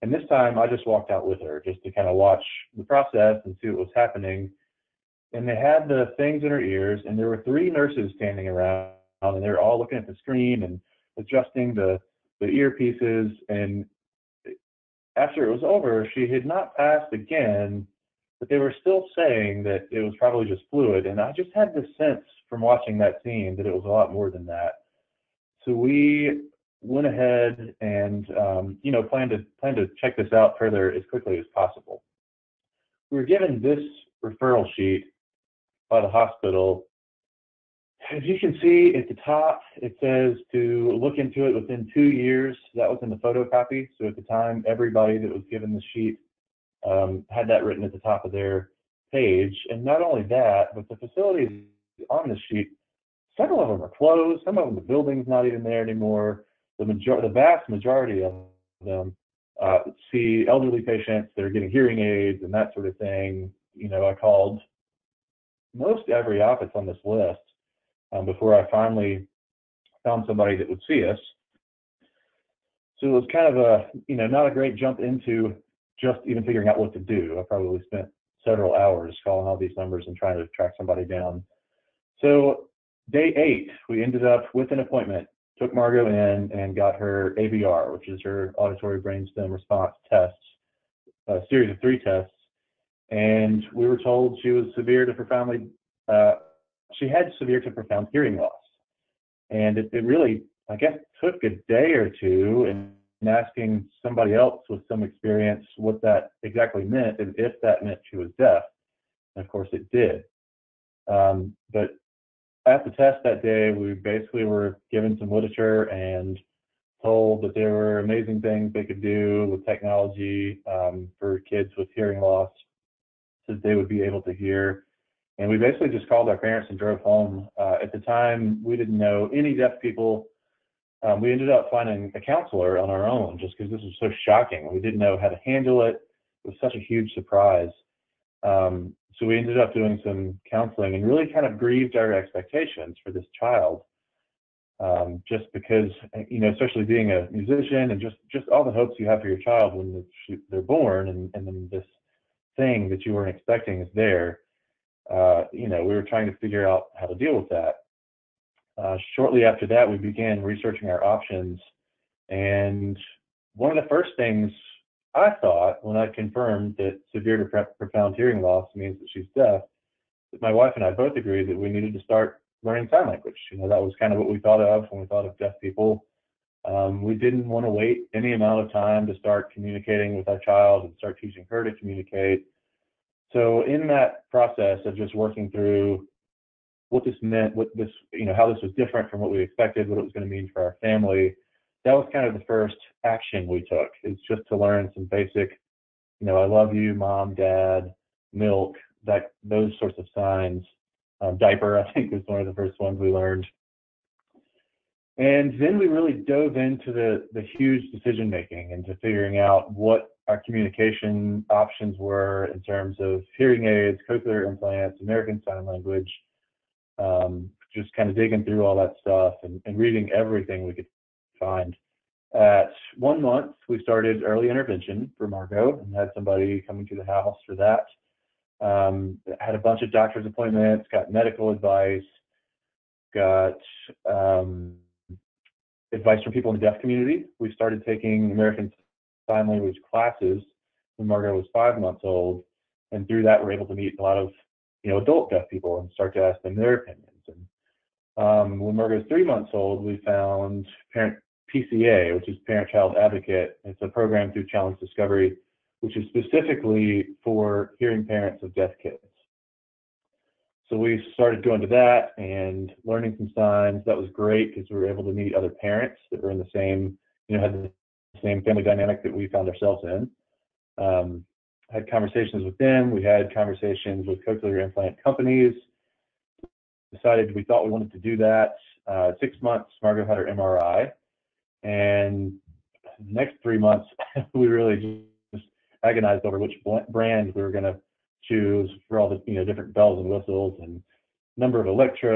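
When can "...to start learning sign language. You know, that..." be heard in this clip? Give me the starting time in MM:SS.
02:51.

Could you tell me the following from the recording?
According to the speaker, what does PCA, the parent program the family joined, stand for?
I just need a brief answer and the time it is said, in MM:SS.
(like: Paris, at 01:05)
Parent Child Advocate, at 04:12.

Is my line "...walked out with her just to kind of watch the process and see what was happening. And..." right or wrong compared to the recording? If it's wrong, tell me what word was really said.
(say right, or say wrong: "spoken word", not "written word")
right.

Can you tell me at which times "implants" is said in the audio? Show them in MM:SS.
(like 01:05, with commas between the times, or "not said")
03:34, 04:34.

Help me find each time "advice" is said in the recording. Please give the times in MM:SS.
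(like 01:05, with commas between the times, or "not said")
03:51, 03:55.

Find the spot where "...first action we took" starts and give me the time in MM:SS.
03:12.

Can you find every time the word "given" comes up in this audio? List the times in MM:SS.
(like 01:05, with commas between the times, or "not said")
00:33, 00:45, 01:54.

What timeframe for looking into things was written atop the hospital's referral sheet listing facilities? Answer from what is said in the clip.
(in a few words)
within 2 years.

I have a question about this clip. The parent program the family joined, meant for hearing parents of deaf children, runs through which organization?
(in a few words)
Challenge Discovery.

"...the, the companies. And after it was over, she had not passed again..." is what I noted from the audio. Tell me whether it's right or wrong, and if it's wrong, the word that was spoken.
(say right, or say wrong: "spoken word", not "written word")
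wrong: "earpieces", not "companies".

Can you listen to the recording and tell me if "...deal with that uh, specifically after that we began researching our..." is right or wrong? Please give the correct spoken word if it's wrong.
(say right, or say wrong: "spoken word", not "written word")
wrong: "shortly", not "specifically".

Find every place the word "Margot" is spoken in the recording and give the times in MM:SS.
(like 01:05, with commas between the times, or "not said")
01:25, 03:45, 04:01, 04:08, 04:39.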